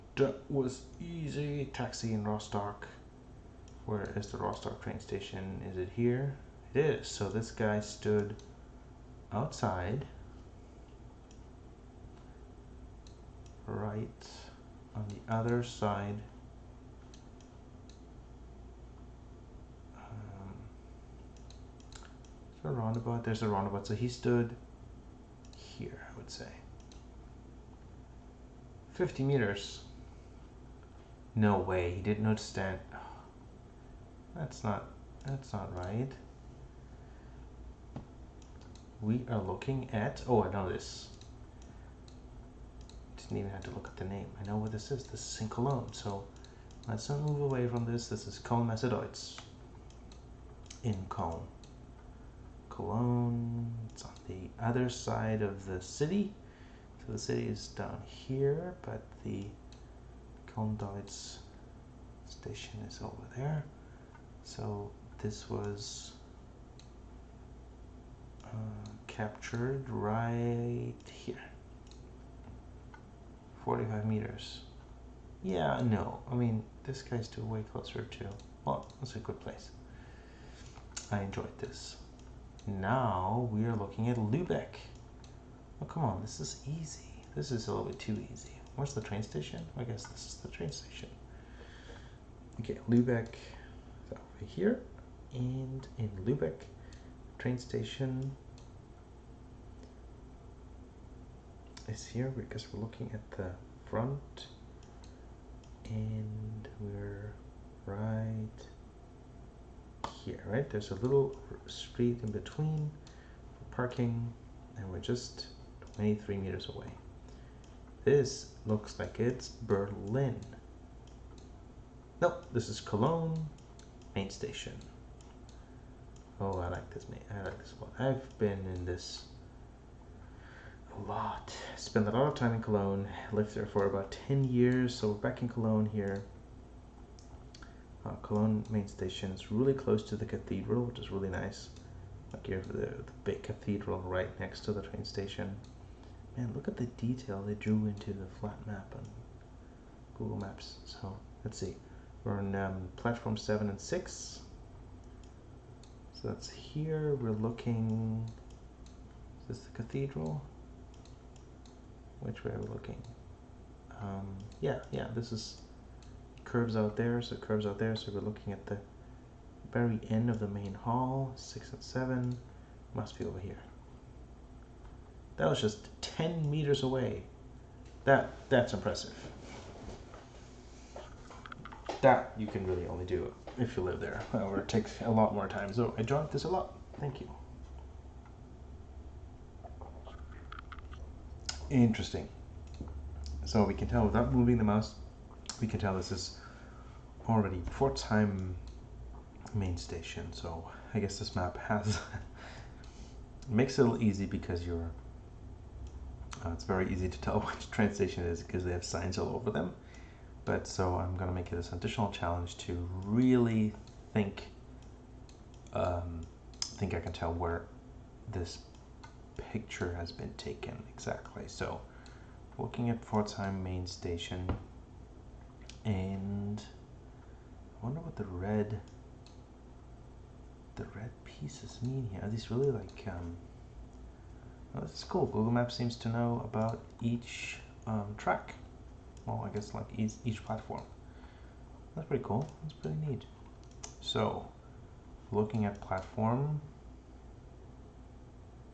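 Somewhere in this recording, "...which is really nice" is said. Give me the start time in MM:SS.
02:20.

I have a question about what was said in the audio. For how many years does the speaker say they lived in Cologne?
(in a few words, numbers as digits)
10 years.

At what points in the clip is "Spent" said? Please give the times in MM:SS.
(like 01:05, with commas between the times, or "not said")
02:11.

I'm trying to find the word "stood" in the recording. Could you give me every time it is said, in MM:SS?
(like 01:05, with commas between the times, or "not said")
00:07, 00:24.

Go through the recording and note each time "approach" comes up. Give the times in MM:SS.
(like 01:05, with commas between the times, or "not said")
not said.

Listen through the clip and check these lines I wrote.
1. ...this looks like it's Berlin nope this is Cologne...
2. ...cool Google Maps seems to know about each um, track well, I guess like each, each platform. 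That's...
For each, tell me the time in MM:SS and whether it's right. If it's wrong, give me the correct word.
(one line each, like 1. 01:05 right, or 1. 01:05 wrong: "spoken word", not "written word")
1. 01:58 right
2. 03:55 right.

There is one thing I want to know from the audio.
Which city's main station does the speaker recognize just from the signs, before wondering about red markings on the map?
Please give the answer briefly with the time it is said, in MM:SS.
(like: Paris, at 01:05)
Pforzheim, at 03:43.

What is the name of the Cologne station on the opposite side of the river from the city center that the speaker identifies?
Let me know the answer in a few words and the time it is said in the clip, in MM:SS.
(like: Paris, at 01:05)
Köln-Deutz, at 01:00.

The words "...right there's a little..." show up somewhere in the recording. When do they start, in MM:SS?
01:50.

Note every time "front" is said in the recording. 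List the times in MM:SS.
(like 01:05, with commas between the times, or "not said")
01:43.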